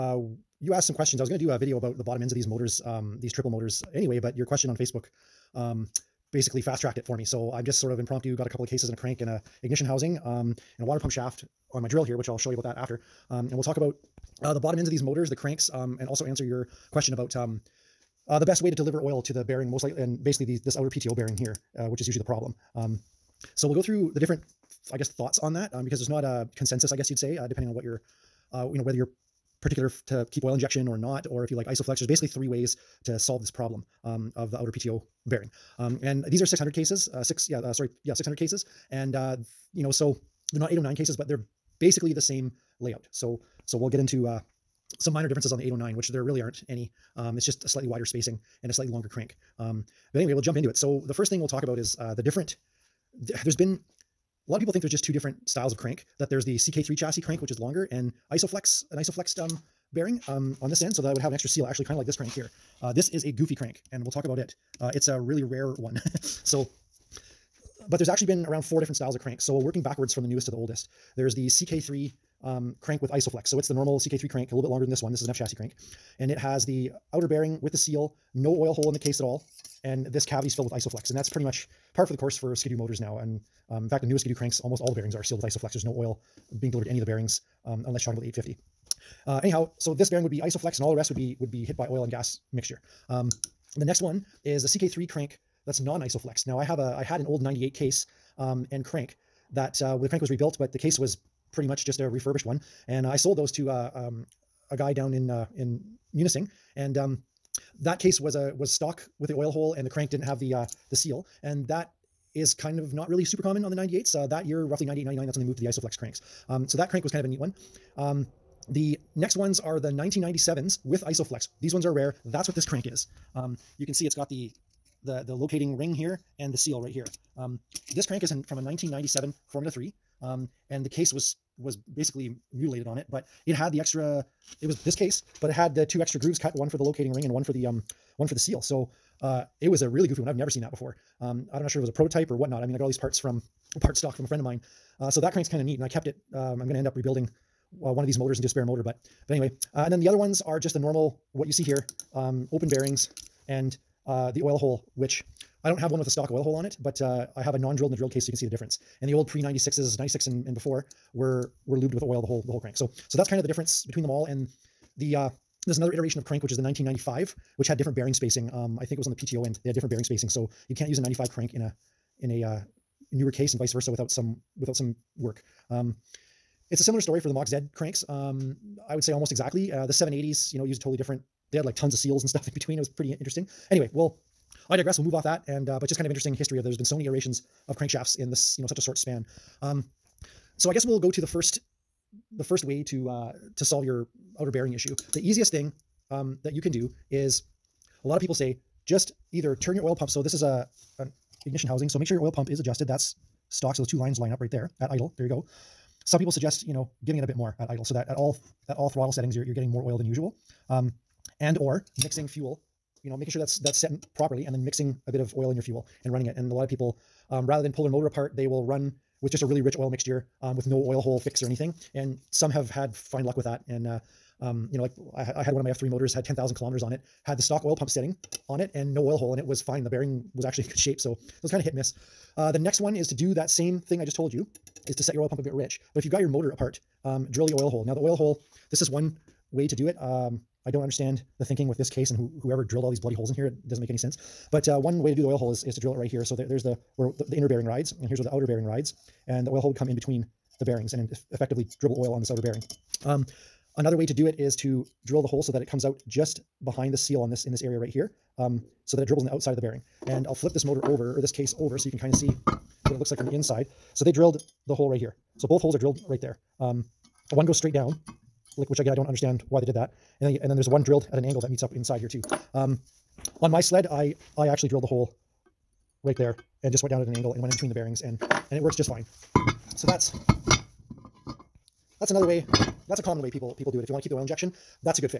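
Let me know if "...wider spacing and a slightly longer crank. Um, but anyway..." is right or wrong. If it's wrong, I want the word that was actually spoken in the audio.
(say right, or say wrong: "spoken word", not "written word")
right.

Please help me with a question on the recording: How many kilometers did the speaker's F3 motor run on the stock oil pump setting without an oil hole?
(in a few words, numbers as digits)
10,000.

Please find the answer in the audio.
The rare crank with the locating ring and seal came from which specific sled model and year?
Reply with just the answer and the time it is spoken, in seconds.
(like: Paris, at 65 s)
1997 Formula 3, at 128 s.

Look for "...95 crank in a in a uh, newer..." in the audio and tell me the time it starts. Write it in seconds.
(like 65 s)
171 s.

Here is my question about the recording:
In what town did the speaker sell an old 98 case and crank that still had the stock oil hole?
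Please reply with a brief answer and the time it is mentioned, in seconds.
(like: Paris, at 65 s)
Munising, at 106 s.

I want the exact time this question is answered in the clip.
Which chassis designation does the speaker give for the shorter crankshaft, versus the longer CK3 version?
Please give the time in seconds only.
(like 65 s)
75 s.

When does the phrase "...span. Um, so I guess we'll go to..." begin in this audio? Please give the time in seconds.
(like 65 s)
188 s.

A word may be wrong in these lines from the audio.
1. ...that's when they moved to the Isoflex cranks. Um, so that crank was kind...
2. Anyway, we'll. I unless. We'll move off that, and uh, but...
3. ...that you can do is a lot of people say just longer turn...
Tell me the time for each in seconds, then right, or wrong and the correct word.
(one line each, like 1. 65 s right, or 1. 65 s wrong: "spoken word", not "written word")
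1. 115 s right
2. 183 s wrong: "digress", not "unless"
3. 196 s wrong: "either", not "longer".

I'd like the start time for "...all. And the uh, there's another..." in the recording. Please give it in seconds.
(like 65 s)
164 s.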